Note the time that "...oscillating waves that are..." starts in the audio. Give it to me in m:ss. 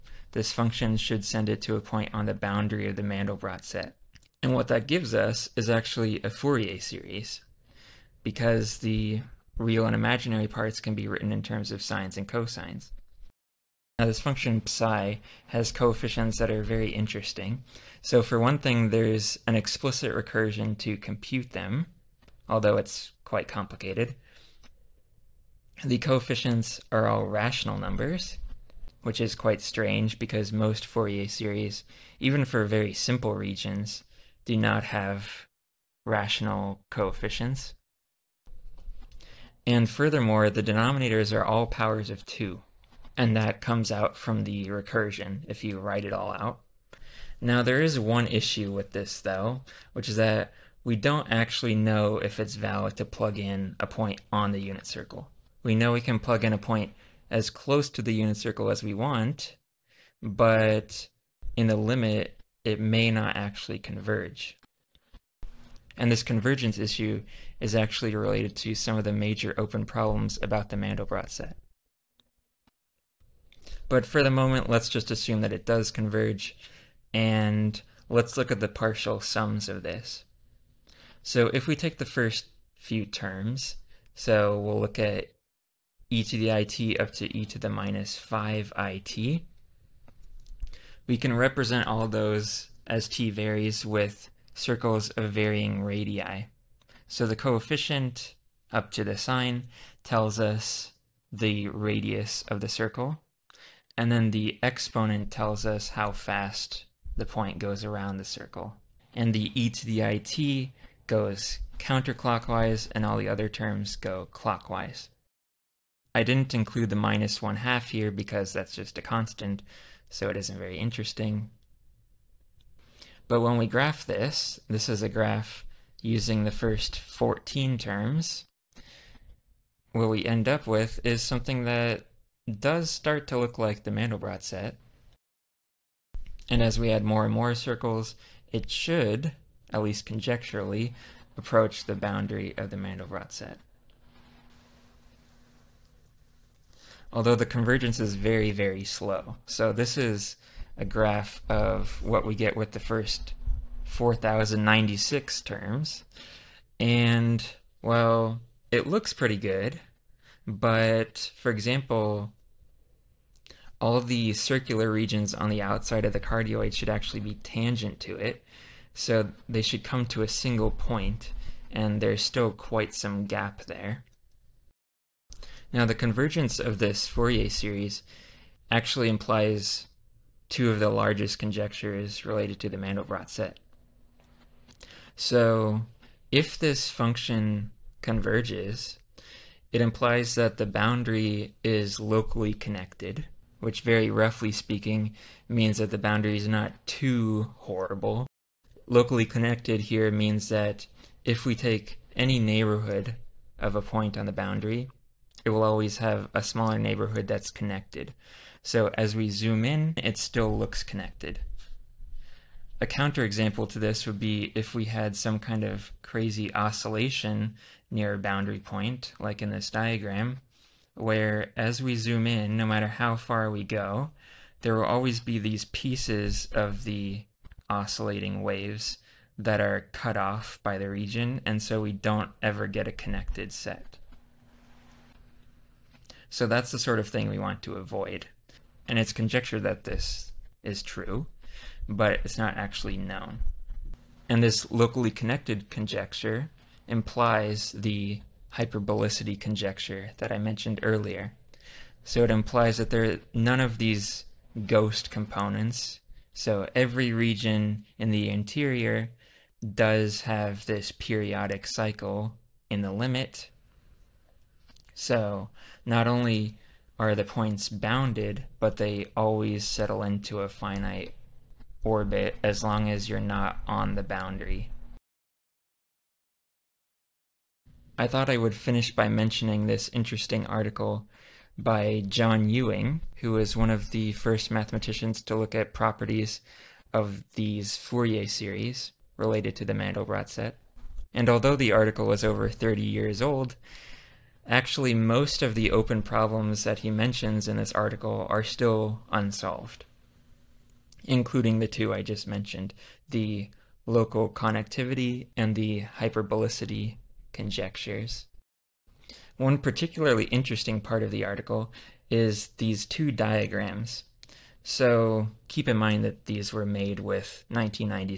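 3:47.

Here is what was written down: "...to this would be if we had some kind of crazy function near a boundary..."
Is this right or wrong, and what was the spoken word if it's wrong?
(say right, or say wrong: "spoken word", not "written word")
wrong: "oscillation", not "function".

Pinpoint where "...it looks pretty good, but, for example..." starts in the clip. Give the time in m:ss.
2:38.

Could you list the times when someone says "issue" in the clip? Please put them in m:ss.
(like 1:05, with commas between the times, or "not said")
0:48, 1:06.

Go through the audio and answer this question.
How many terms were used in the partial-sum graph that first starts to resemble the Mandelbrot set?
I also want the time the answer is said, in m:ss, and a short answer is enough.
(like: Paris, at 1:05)
14, at 2:06.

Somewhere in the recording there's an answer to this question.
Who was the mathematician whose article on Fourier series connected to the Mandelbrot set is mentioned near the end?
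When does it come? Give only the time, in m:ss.
4:42.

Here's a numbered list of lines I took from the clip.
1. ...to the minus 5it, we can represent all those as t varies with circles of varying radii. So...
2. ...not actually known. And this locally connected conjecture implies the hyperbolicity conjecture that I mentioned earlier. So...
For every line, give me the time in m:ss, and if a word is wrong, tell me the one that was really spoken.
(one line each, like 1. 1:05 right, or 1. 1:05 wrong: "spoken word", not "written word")
1. 1:27 right
2. 4:02 right.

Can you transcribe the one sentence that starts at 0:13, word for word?
Now this function psi has coefficients that are very interesting.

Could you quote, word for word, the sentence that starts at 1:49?
And the e to the it goes counterclockwise, and all the other terms go clockwise.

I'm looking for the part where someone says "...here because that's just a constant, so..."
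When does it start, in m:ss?
1:57.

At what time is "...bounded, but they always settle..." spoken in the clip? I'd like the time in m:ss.
4:27.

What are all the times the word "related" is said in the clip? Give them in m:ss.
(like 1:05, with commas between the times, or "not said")
1:08, 3:02, 4:49.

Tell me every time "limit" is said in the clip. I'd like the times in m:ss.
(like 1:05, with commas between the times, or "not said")
1:01, 4:22.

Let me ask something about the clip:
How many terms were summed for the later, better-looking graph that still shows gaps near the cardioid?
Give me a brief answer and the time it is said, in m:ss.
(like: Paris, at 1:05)
4,096, at 2:33.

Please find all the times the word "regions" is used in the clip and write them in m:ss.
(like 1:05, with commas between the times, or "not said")
0:33, 2:44, 3:50, 4:17.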